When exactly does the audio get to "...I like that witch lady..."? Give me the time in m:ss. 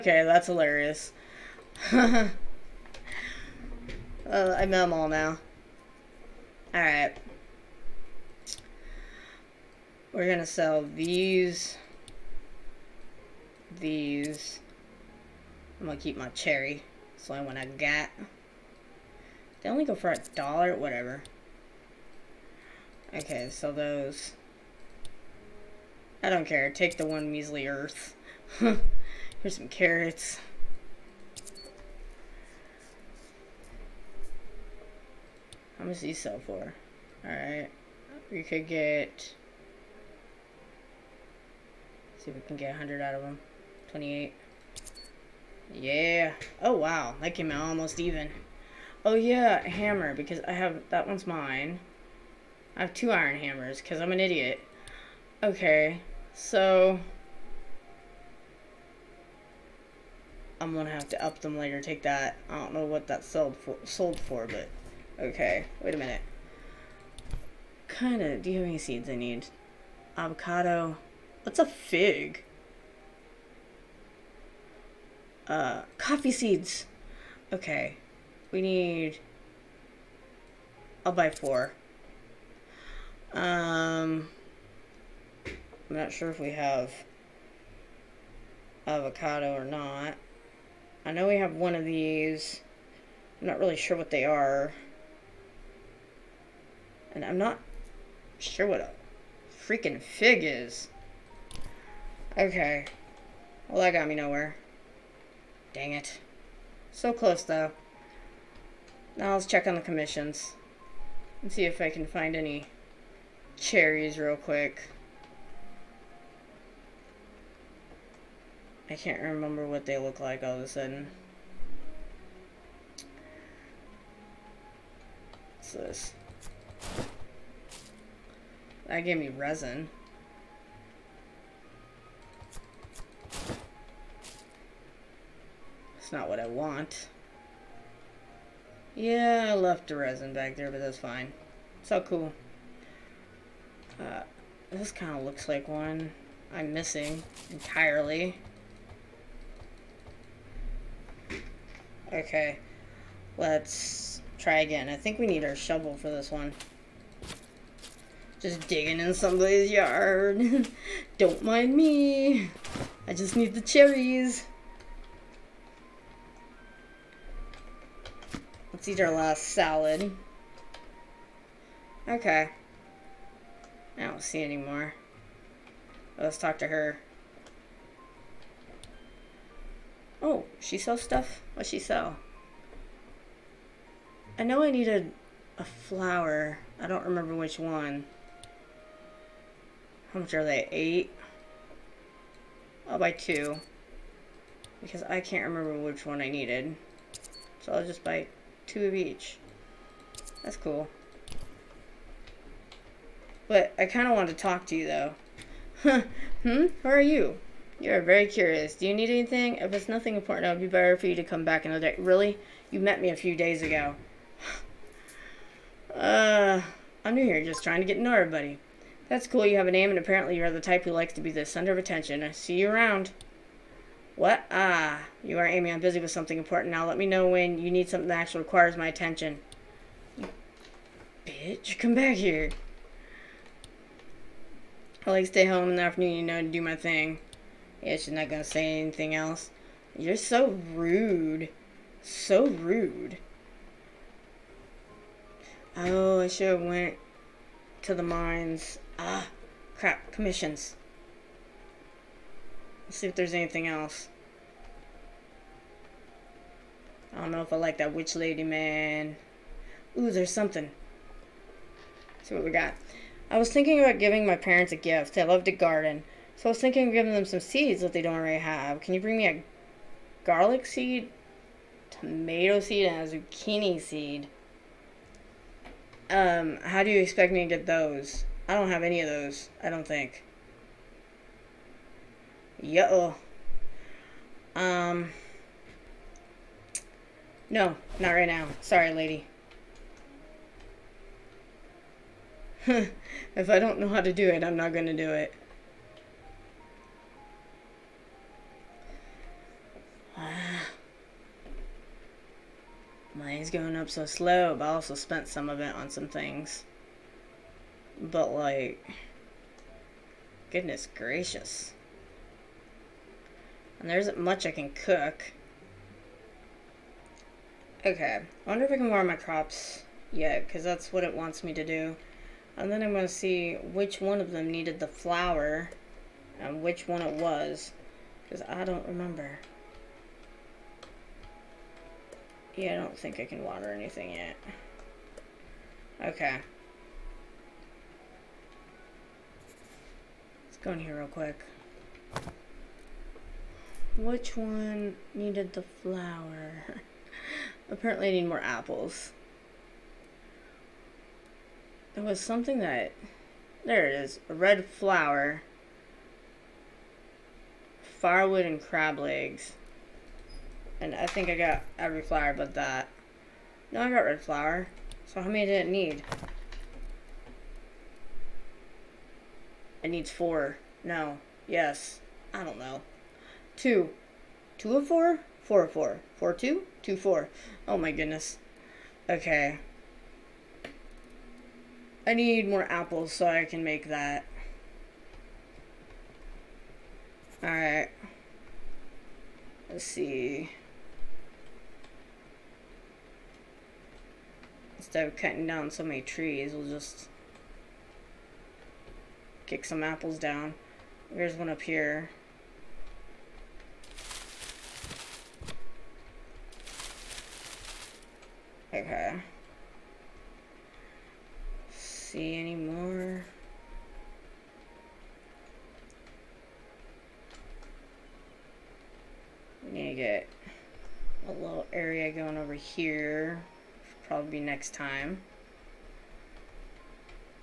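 4:17.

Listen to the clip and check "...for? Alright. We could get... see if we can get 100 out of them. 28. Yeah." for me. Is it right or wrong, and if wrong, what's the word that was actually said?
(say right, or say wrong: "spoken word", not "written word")
right.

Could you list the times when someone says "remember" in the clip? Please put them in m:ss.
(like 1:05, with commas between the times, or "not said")
1:59, 3:07, 3:15, 5:28.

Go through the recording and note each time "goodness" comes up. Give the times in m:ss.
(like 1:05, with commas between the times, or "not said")
5:10, 6:17.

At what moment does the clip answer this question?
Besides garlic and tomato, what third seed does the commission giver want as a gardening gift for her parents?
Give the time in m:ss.
4:33.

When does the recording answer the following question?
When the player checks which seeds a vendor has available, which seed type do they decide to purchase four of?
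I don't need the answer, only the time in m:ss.
1:15.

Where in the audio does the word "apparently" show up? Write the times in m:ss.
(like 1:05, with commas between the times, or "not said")
3:39, 5:47.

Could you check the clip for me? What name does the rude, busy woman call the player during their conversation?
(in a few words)
Amy.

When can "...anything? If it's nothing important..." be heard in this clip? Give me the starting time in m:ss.
3:29.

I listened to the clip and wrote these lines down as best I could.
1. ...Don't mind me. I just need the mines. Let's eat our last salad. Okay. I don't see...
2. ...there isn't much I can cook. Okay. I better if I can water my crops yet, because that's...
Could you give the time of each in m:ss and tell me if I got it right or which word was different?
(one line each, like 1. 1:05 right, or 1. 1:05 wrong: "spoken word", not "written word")
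1. 2:41 wrong: "cherries", not "mines"
2. 5:13 wrong: "wonder", not "better".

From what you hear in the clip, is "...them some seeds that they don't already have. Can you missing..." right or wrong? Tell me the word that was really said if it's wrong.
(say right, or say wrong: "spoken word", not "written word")
wrong: "bring", not "missing".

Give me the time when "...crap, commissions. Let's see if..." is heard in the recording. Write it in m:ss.
4:09.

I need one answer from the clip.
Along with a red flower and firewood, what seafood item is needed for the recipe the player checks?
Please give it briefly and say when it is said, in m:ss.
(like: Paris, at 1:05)
Crab legs, at 5:58.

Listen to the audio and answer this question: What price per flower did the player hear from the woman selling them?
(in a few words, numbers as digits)
8.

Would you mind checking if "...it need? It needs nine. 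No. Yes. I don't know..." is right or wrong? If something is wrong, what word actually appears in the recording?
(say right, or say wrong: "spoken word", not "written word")
wrong: "four", not "nine".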